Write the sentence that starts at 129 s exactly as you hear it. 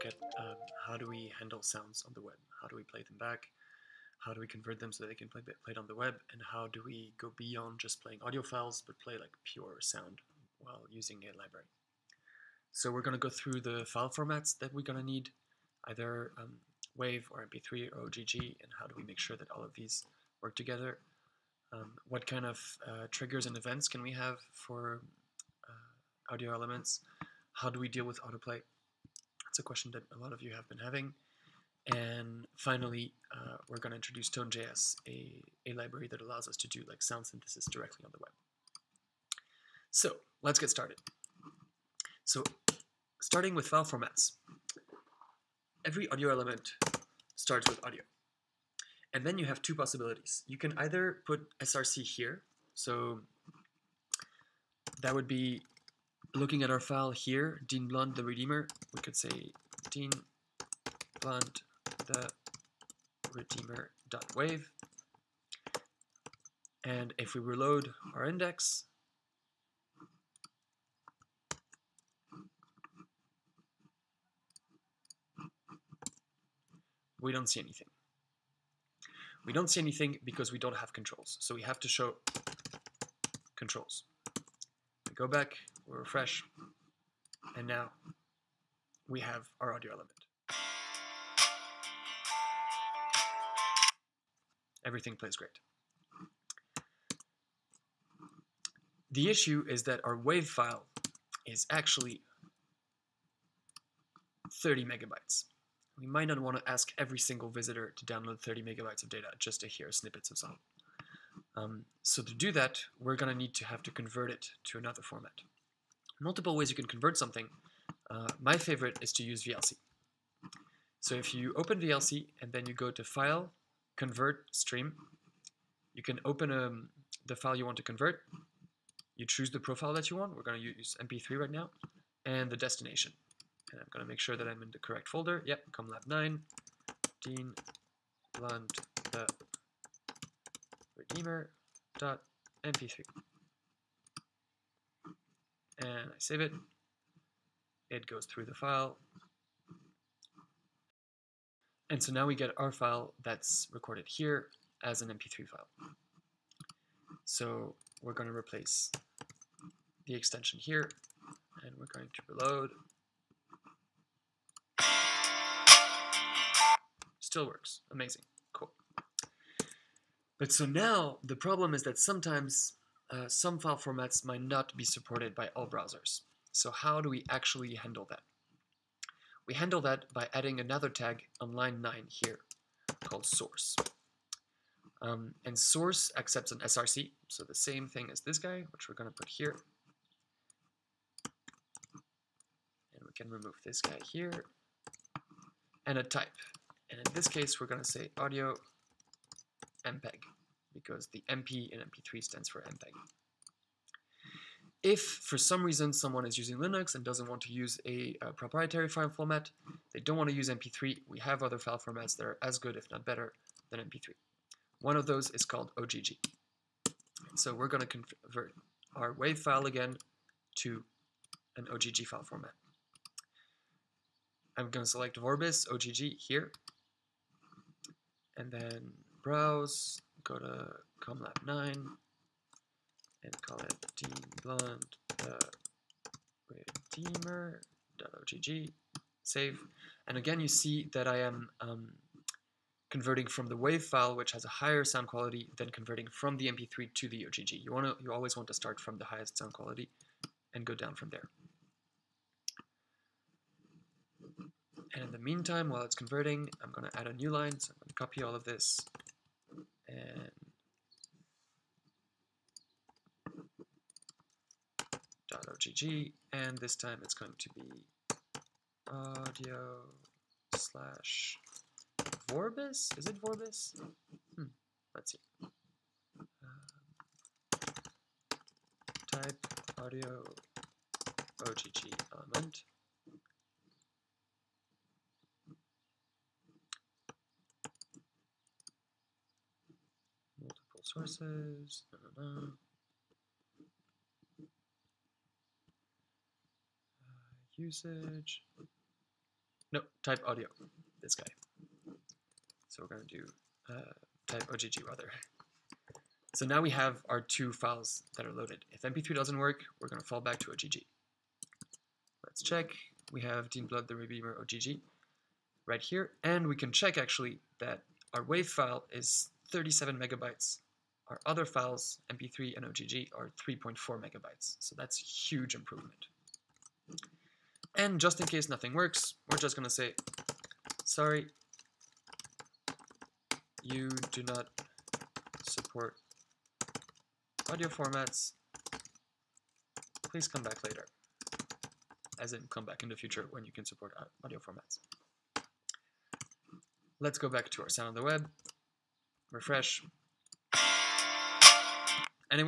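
You choose the profile that you want.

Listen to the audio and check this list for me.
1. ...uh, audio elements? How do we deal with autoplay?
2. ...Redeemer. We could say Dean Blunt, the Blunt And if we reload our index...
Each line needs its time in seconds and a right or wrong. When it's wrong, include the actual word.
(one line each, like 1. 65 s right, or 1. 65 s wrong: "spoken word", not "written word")
1. 25 s right
2. 58 s wrong: "Redeemer", not "Blunt".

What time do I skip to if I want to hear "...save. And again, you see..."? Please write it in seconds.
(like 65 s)
239 s.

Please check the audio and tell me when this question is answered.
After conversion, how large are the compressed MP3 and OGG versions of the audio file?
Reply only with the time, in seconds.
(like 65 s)
323 s.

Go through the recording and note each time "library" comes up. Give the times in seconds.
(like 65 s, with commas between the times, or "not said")
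11 s, 35 s.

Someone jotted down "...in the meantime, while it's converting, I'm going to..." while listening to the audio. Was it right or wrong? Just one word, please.
right.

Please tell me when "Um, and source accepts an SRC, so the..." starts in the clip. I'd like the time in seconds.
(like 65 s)
185 s.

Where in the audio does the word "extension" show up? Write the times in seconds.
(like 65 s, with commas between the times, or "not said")
160 s.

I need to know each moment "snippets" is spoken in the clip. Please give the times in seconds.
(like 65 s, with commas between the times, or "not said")
109 s.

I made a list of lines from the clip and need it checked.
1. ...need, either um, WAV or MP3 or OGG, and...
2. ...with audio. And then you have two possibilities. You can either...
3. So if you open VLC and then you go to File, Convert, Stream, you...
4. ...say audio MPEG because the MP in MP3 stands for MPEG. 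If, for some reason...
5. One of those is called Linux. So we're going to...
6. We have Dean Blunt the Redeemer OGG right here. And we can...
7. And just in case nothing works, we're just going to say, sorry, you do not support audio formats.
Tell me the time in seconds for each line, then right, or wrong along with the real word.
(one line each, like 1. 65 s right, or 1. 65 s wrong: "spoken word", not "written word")
1. 15 s right
2. 47 s right
3. 121 s right
4. 197 s right
5. 214 s wrong: "OGG", not "Linux"
6. 313 s right
7. 327 s right.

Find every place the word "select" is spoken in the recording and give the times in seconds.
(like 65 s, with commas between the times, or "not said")
224 s.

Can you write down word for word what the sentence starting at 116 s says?
Multiple ways you can convert something.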